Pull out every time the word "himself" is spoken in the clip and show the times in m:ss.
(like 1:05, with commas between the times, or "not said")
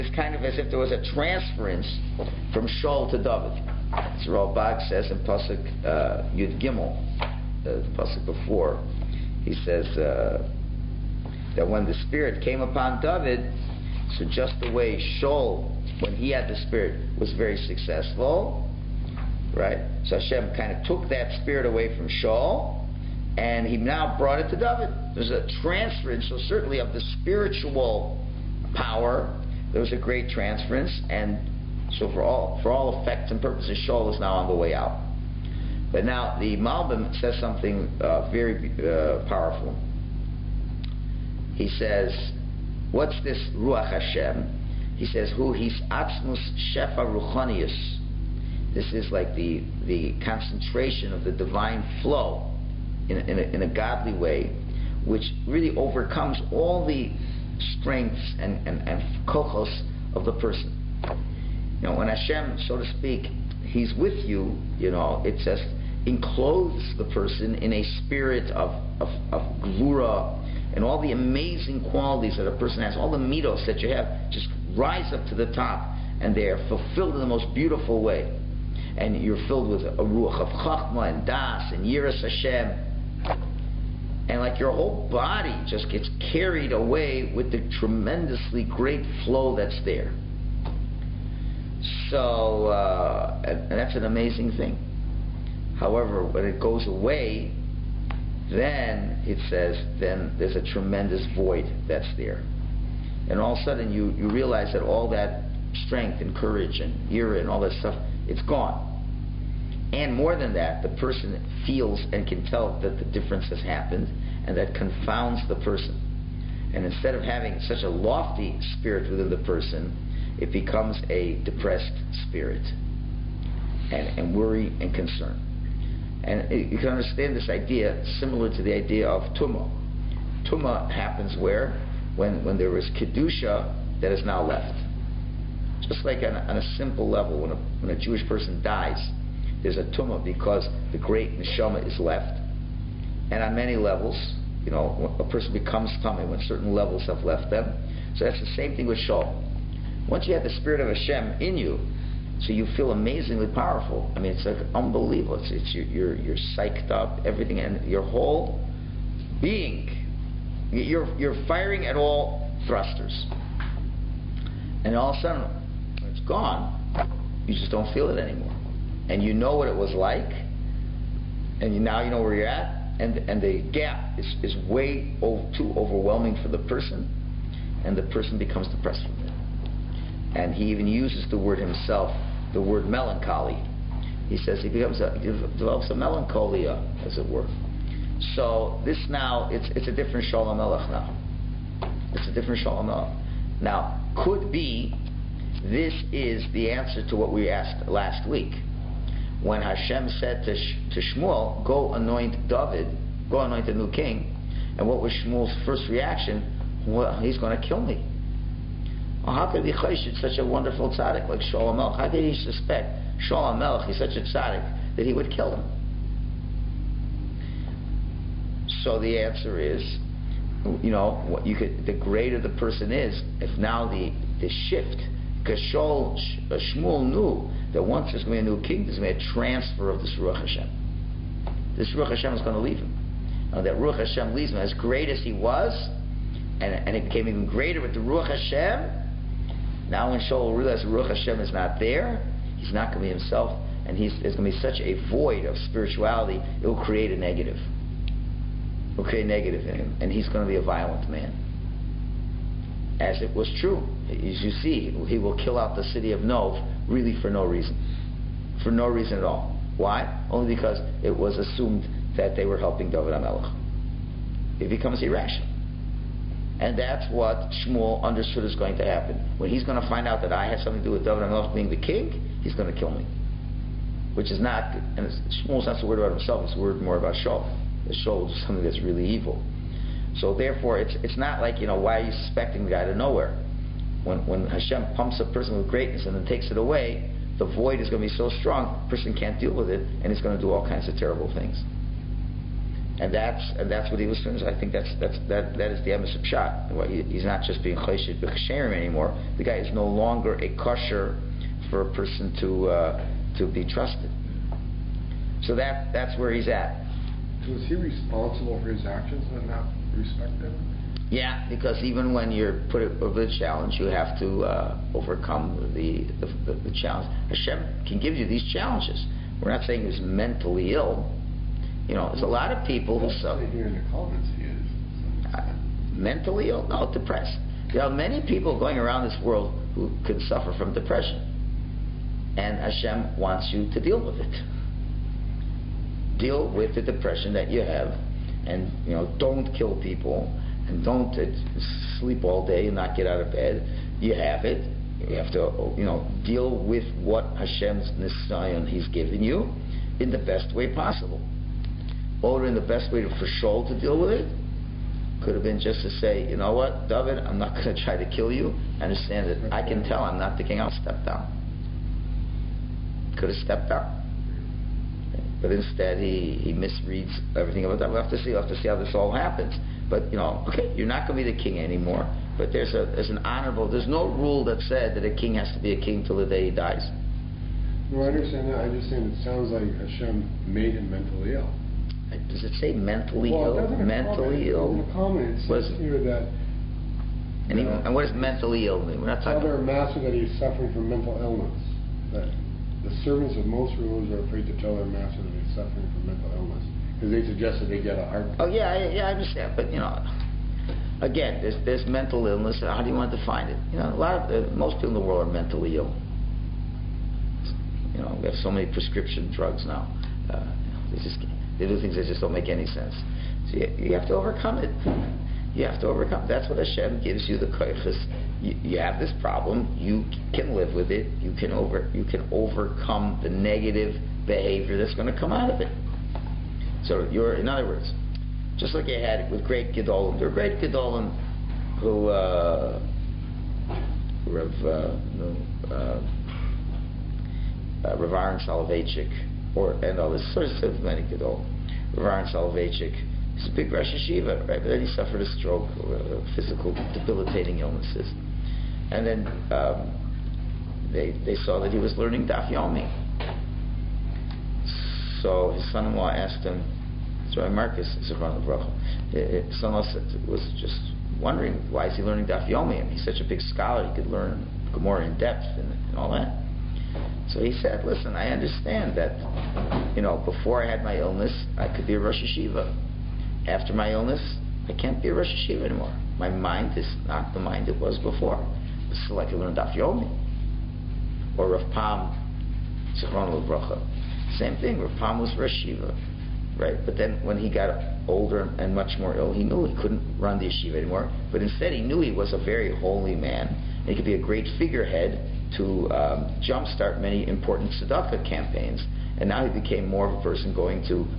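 3:01, 4:03, 4:36.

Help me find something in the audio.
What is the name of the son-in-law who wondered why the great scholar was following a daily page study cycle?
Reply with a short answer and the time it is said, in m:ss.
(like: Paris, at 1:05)
Rabbi Marcus, at 7:37.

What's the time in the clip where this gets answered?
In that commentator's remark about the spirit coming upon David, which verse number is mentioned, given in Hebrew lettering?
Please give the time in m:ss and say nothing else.
0:06.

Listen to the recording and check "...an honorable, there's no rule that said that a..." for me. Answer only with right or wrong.
right.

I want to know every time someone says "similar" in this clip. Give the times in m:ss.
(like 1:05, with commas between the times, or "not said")
2:08.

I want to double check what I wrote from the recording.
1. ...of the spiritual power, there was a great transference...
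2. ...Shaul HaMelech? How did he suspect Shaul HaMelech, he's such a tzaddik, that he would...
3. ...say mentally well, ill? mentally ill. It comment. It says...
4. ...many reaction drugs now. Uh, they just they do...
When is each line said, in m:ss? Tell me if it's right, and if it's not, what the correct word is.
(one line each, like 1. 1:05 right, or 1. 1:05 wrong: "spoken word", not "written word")
1. 0:26 right
2. 3:31 right
3. 6:22 right
4. 6:48 wrong: "prescription", not "reaction".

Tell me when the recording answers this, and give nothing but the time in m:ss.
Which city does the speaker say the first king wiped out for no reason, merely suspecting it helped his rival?
4:16.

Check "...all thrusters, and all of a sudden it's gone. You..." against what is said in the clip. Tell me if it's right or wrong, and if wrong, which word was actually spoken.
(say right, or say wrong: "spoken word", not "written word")
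right.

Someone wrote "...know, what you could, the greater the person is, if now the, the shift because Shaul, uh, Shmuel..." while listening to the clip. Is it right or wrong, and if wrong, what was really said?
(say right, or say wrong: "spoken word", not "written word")
right.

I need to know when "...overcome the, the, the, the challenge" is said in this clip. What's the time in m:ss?
5:14.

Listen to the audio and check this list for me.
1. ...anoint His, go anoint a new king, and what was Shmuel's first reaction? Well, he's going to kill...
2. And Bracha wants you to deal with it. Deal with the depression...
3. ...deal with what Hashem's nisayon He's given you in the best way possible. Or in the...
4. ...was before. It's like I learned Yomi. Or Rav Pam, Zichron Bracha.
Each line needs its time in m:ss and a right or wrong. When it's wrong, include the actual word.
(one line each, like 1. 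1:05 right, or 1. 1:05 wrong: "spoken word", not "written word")
1. 3:21 wrong: "David", not "His"
2. 5:32 wrong: "Hashem", not "Bracha"
3. 5:46 right
4. 7:57 right.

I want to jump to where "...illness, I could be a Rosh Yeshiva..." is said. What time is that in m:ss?
7:50.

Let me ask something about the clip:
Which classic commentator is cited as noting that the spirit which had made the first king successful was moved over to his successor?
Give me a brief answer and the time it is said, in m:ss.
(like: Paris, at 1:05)
Radak, at 0:04.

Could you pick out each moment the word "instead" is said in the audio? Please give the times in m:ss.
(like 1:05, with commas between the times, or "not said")
1:56, 6:05, 8:11.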